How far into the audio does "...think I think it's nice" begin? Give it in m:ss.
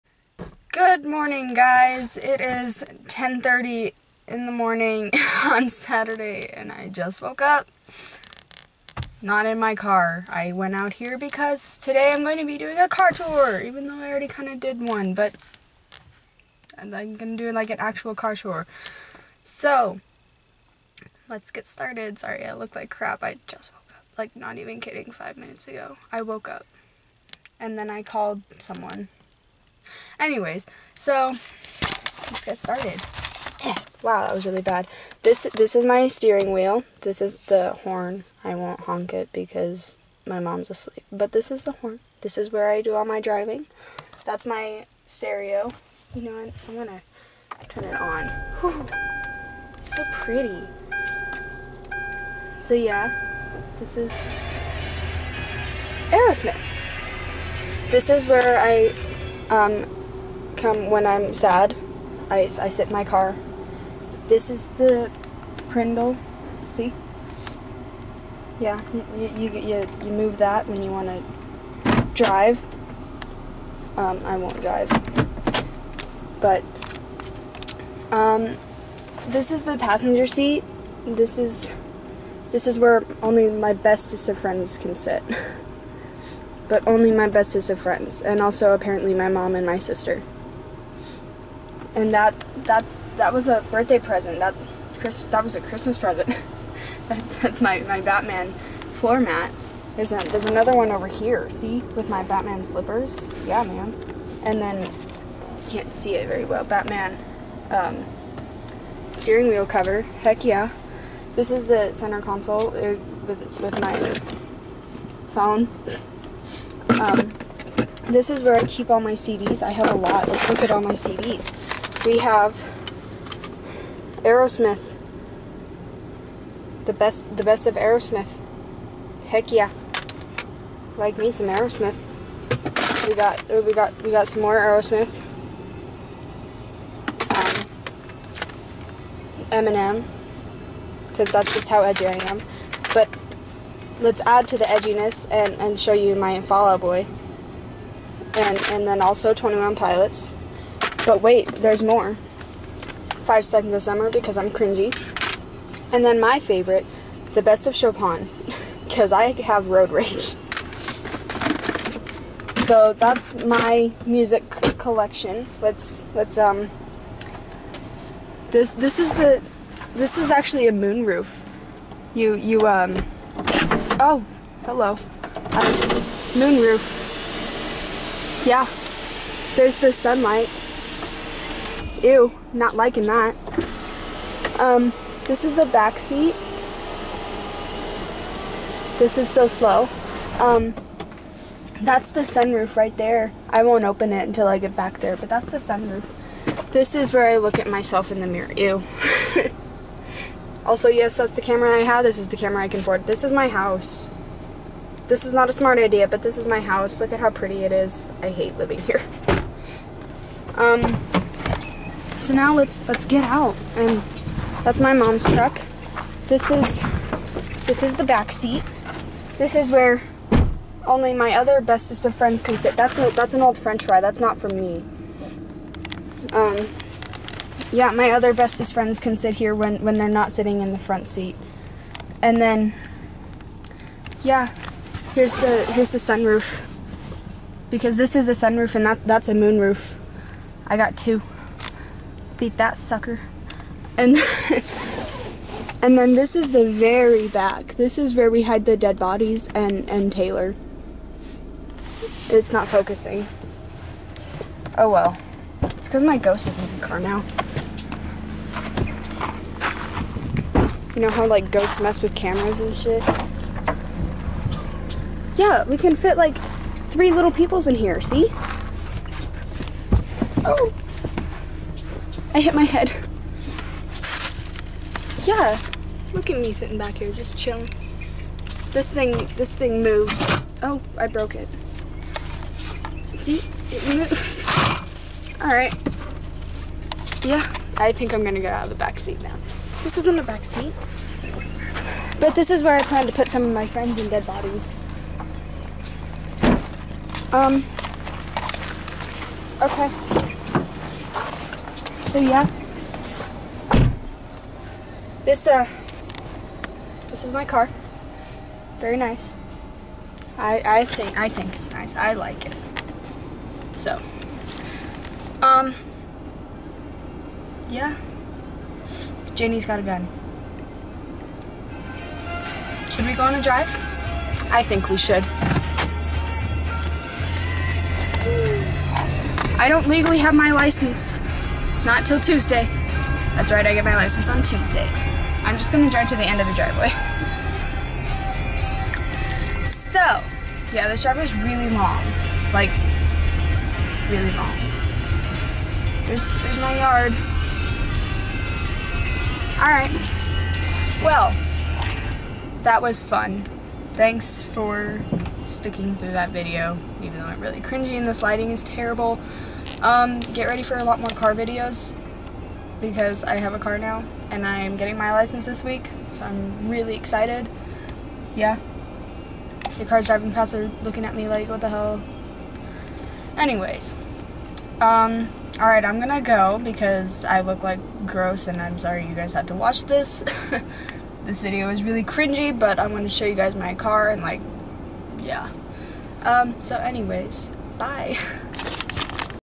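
5:10.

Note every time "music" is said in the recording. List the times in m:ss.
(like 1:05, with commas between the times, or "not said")
2:44.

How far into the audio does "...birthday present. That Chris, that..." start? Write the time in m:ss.
1:33.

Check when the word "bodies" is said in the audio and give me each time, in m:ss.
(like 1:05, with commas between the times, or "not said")
4:08, 4:54.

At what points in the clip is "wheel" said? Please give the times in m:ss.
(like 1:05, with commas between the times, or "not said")
0:36, 1:49.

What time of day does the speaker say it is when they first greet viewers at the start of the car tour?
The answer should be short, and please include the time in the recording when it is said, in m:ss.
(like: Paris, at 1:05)
10:30, at 0:03.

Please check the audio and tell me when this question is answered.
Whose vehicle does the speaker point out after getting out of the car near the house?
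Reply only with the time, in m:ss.
3:34.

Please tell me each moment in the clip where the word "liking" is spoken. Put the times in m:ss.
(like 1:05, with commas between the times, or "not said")
3:02.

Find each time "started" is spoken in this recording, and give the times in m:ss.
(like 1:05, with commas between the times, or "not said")
0:21, 0:32.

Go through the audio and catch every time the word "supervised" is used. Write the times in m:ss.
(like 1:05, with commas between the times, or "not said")
not said.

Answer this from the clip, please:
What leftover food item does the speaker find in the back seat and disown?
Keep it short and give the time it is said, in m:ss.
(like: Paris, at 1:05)
French fry, at 3:43.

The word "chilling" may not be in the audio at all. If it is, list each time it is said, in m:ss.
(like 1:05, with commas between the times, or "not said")
4:37.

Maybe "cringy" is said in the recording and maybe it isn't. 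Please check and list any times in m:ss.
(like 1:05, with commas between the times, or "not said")
2:34, 5:57, 6:22.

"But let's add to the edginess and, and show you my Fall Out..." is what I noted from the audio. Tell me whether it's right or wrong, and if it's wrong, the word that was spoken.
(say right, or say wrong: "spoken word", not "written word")
right.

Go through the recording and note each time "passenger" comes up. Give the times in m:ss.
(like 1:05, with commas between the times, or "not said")
1:19.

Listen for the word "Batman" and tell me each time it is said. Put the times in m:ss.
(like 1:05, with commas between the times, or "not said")
1:37, 1:42, 1:46.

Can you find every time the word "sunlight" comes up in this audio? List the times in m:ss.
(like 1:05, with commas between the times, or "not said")
2:59.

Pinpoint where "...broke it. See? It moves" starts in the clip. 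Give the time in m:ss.
4:41.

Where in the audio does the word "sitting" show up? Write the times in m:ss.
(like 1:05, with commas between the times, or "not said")
3:50, 4:36.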